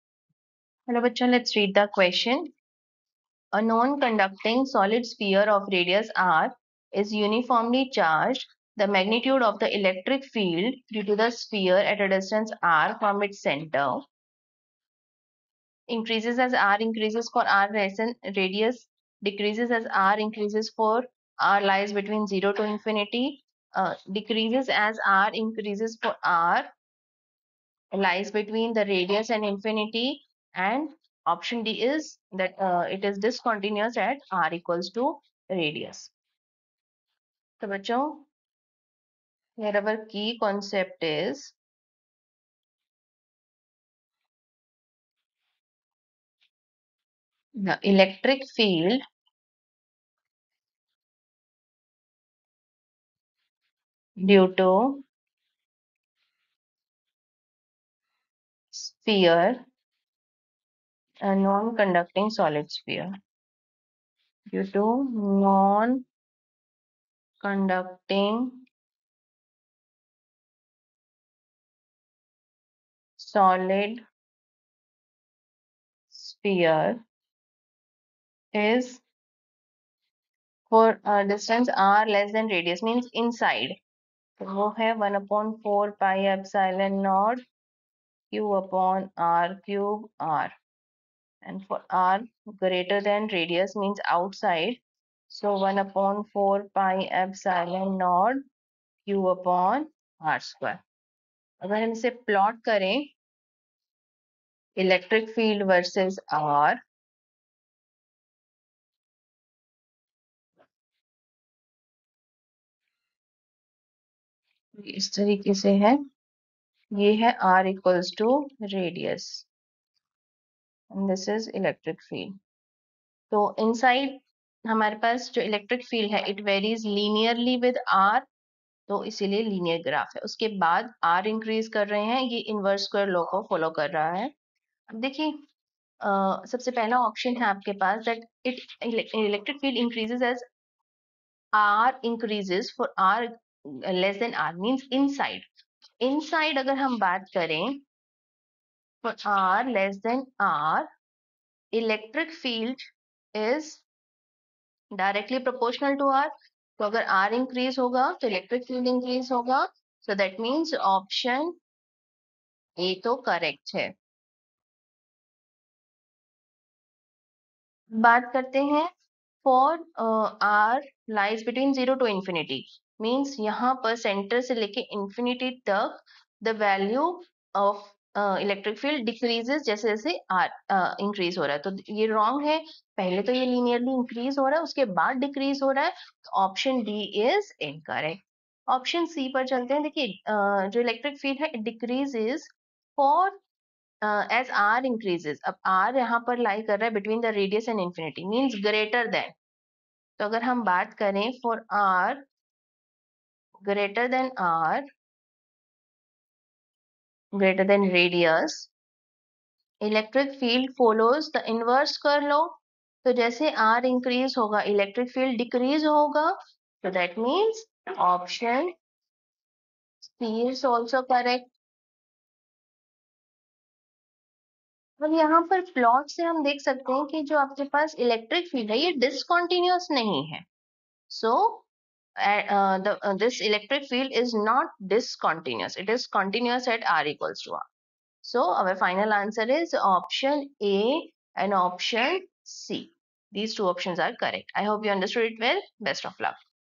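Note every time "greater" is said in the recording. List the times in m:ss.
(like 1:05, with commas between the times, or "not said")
1:32, 3:27.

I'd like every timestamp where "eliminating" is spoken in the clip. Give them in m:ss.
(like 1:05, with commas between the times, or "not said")
not said.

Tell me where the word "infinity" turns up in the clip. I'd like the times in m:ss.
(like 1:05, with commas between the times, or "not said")
0:22, 0:29.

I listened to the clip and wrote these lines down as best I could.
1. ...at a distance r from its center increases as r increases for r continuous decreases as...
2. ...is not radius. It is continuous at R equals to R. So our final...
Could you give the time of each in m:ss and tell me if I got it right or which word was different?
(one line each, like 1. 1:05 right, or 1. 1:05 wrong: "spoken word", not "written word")
1. 0:11 wrong: "radius", not "continuous"
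2. 3:54 wrong: "discontinuous", not "radius".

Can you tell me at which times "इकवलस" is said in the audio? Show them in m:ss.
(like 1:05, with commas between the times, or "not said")
1:57.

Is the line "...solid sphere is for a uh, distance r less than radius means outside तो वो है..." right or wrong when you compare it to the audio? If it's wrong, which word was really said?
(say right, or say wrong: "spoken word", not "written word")
wrong: "inside", not "outside".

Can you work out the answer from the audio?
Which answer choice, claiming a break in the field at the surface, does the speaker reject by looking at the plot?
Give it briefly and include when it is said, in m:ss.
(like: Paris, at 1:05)
option D, at 0:31.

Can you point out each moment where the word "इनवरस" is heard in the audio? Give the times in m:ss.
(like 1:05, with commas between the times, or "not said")
2:12, 3:31.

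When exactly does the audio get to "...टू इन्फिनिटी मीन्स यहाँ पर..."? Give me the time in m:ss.
2:52.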